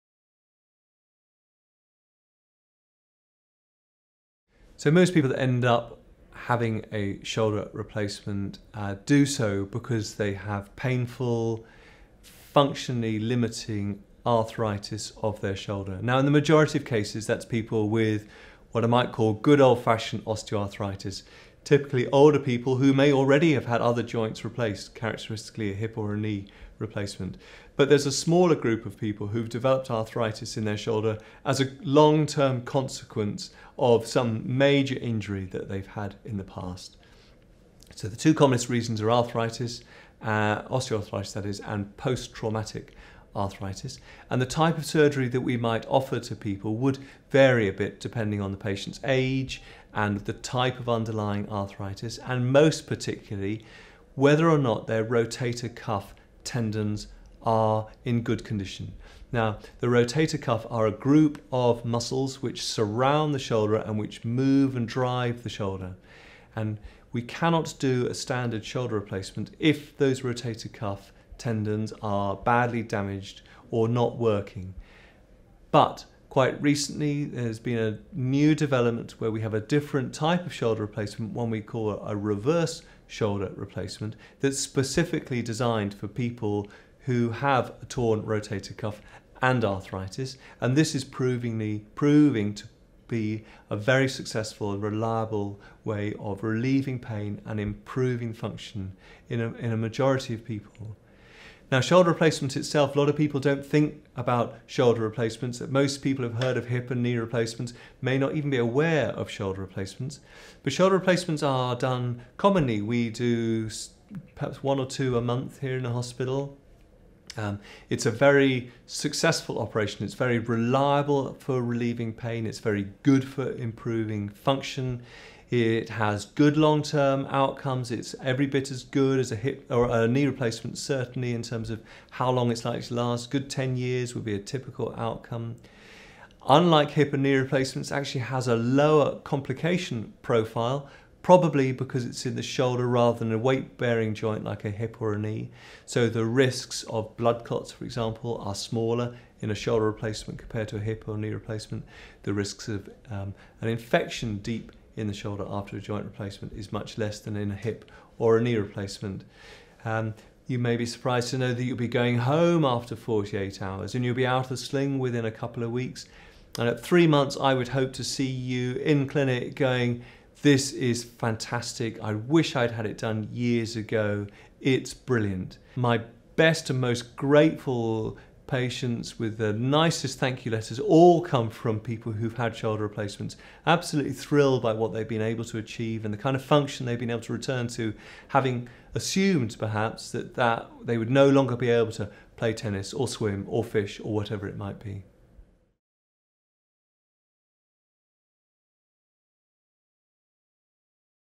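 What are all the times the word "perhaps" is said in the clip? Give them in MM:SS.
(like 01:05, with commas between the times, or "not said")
01:54, 03:09.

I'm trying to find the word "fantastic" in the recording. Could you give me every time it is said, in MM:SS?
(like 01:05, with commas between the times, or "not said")
02:51.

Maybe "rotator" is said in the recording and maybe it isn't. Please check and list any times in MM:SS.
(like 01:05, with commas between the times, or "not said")
00:55, 00:59, 01:10, 01:28.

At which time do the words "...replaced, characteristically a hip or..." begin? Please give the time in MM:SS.
00:24.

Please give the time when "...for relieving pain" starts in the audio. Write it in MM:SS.
02:01.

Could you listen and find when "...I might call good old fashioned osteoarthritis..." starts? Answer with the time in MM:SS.
00:18.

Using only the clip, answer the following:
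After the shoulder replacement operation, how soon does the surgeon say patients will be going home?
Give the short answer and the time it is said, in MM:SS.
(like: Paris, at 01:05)
48 hours, at 02:42.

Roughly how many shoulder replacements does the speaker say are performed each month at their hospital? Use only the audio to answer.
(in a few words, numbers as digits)
1 or 2.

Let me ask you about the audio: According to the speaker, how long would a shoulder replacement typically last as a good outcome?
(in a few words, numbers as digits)
10 years.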